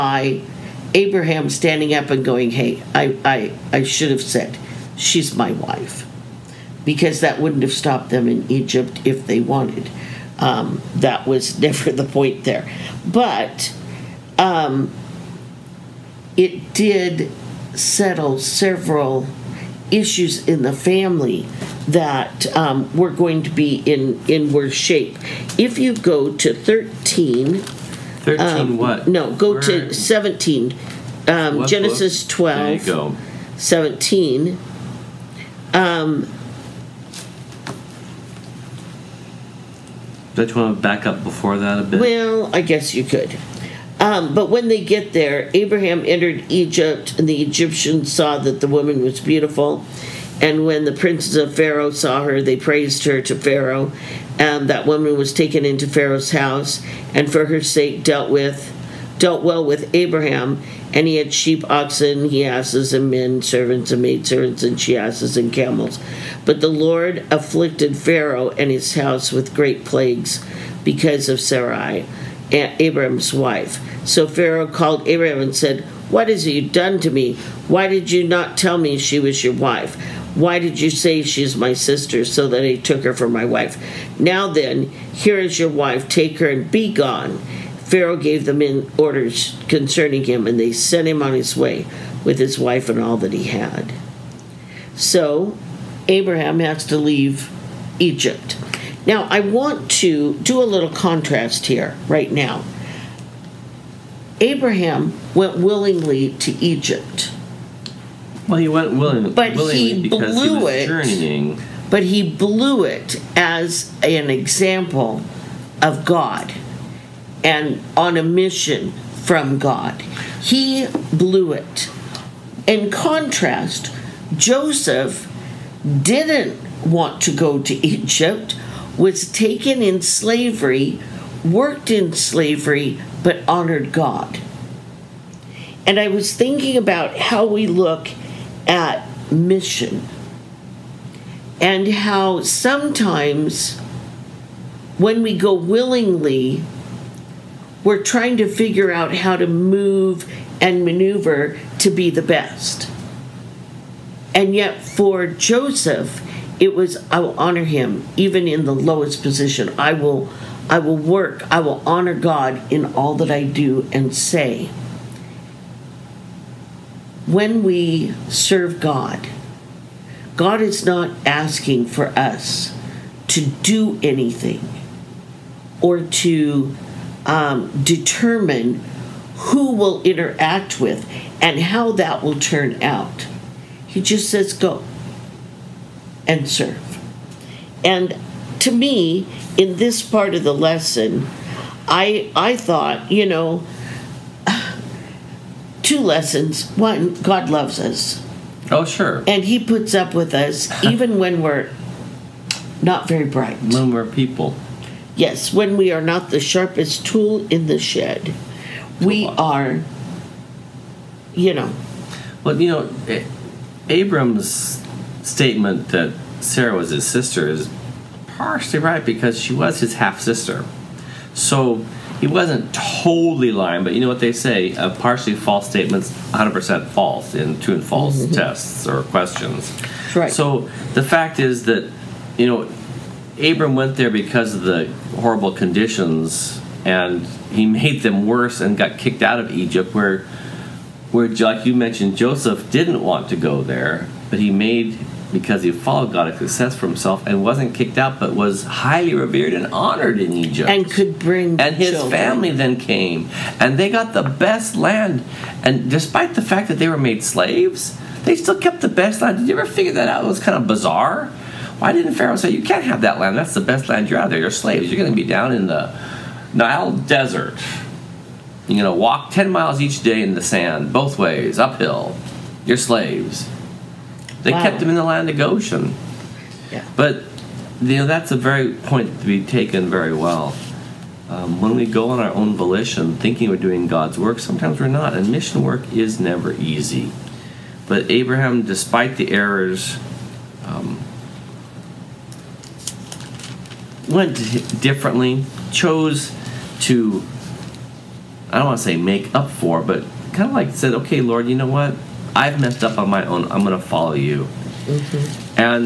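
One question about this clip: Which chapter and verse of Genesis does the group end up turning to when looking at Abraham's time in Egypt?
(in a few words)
12:17.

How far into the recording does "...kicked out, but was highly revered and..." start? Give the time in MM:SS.
04:07.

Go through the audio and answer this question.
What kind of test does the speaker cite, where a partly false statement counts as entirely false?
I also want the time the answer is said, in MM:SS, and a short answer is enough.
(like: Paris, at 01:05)
true and false, at 03:47.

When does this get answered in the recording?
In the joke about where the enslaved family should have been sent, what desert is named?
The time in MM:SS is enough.
04:26.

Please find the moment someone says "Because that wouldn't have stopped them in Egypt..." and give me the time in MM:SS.
00:06.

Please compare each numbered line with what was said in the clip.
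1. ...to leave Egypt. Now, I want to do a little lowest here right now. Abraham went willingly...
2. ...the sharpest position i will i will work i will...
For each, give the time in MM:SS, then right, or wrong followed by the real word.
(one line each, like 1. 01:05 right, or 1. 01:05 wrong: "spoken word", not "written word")
1. 01:36 wrong: "contrast", not "lowest"
2. 02:38 wrong: "lowest", not "sharpest".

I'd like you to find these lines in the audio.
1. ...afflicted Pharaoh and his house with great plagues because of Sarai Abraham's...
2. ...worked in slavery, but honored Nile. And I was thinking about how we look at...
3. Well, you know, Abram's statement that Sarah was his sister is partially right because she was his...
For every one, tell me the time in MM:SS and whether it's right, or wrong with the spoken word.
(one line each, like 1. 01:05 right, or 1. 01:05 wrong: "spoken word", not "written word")
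1. 01:07 right
2. 02:11 wrong: "God", not "Nile"
3. 03:32 right.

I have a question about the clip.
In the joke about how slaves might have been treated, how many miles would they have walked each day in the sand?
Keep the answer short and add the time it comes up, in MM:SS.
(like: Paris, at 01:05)
10, at 04:29.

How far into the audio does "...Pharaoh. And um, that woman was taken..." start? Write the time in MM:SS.
00:53.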